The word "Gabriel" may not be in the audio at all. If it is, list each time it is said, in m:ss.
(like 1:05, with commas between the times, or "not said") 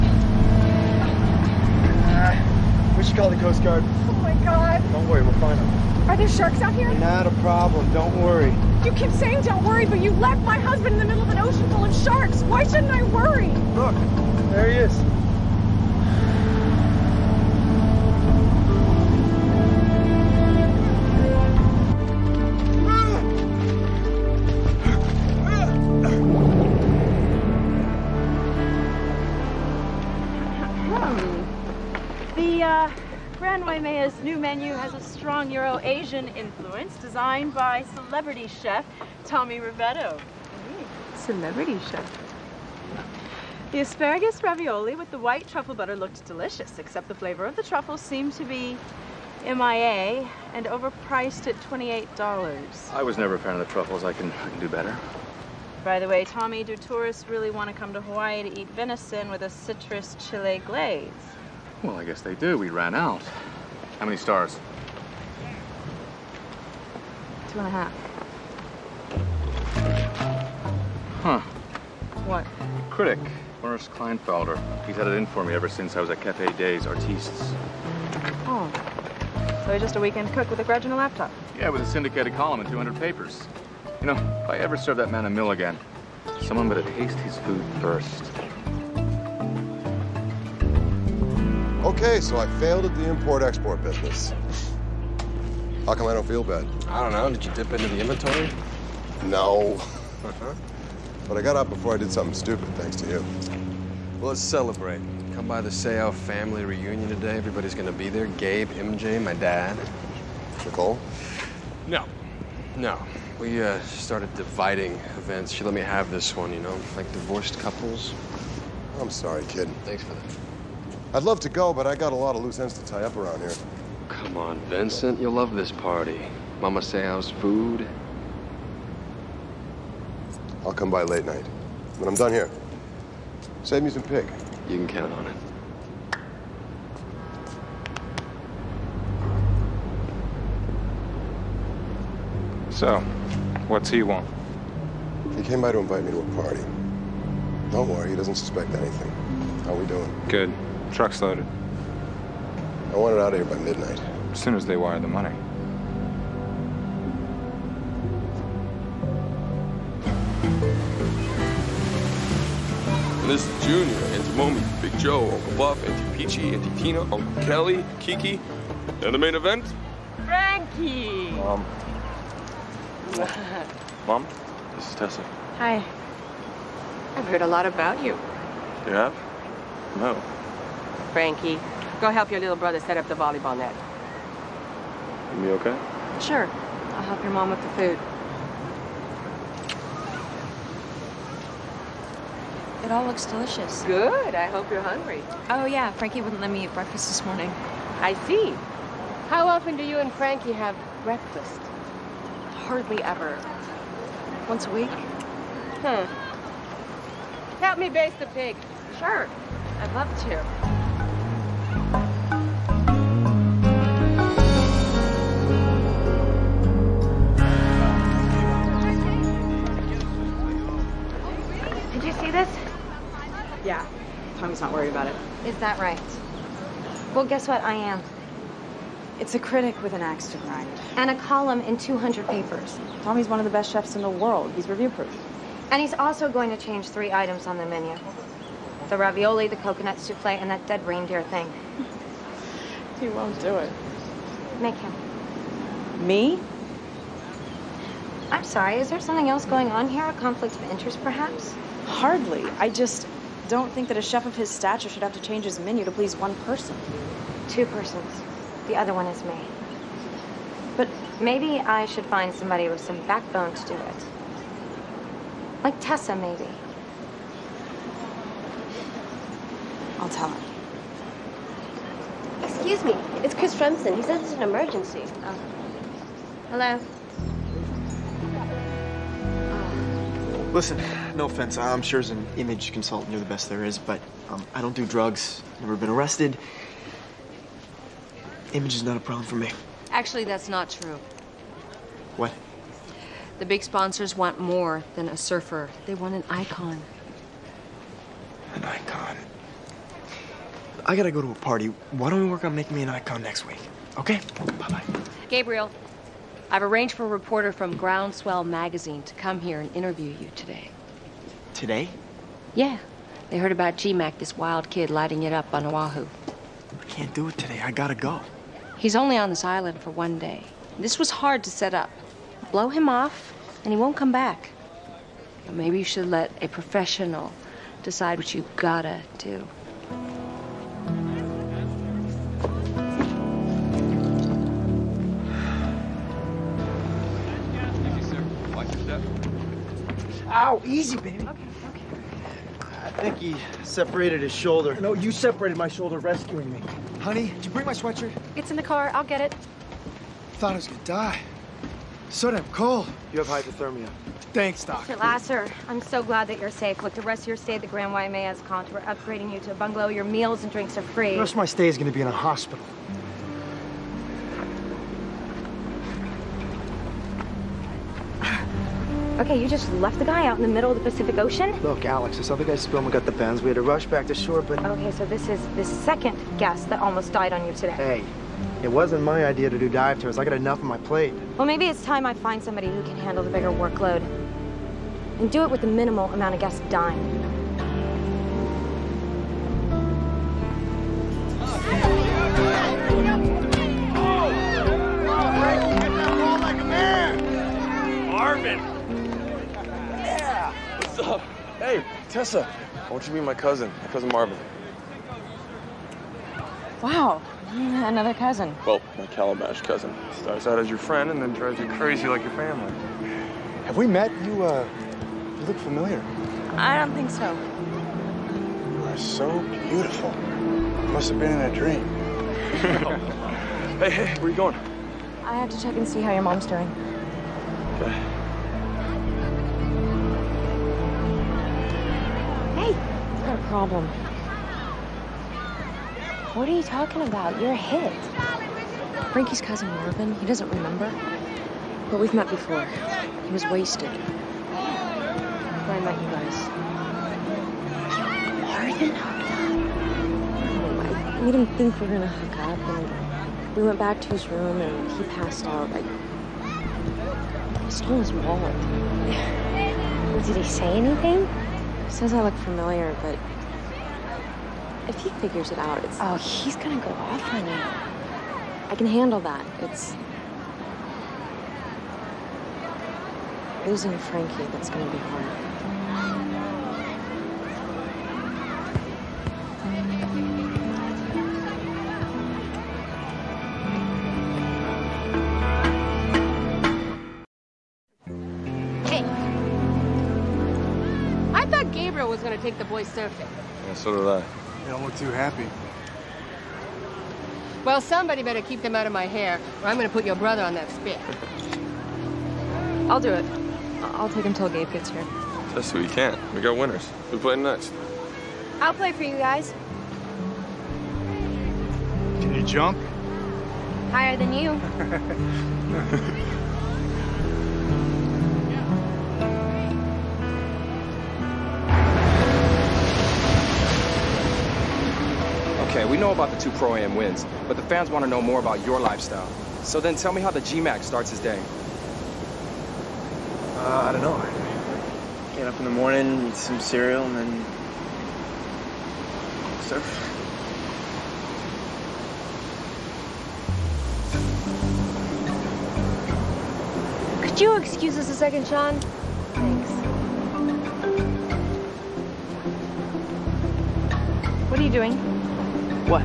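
5:05, 8:11.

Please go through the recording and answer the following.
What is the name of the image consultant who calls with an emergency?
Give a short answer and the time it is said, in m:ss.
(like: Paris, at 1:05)
Chris Fremson, at 4:33.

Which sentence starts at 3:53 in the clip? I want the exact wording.
Tommy's one of the best chefs in the world.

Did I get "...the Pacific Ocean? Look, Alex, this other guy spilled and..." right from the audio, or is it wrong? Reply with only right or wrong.
right.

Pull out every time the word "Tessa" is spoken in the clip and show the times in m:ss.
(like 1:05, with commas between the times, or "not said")
2:54, 4:25, 6:42.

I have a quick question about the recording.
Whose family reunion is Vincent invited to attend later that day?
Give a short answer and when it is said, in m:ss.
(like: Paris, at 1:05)
The Seau family, at 1:45.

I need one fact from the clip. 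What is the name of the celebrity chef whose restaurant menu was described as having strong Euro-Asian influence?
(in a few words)
Tommy Rivetto.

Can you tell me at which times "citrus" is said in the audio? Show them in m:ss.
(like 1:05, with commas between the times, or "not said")
0:59.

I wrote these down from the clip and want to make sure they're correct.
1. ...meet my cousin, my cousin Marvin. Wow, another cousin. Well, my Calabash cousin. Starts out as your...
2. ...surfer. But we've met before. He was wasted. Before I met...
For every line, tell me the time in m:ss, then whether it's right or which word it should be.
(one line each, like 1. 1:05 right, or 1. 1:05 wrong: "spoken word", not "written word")
1. 6:43 right
2. 7:20 wrong: "remember", not "surfer".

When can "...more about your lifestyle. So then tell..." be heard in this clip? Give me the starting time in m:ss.
8:48.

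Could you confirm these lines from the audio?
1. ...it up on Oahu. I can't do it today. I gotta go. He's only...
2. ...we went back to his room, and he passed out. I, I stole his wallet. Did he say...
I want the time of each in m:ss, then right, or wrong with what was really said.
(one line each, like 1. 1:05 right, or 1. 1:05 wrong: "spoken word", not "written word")
1. 5:15 right
2. 7:33 right.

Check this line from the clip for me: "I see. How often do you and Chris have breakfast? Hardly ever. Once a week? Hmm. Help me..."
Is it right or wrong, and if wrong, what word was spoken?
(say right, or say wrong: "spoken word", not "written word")
wrong: "Frankie", not "Chris".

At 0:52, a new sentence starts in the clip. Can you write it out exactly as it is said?
I was never a fan of the truffles.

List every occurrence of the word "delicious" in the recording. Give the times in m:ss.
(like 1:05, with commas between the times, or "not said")
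0:46, 3:13.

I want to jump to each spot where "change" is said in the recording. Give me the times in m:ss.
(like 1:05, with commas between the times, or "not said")
3:56, 4:15.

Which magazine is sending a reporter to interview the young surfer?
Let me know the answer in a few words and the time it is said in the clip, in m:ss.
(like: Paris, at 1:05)
Groundswell, at 5:07.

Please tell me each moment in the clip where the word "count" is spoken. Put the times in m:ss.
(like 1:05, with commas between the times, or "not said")
2:14.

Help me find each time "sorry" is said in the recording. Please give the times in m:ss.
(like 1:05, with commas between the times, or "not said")
1:59, 4:08.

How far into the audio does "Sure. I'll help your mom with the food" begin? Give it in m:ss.
3:06.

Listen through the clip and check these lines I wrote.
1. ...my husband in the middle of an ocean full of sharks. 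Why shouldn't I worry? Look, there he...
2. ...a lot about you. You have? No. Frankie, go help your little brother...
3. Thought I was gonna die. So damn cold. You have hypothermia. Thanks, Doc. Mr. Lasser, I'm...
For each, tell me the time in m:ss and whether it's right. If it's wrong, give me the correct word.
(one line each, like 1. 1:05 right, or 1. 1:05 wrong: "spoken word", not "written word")
1. 0:10 right
2. 2:57 right
3. 5:50 right.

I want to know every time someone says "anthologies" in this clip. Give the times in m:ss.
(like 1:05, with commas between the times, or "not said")
not said.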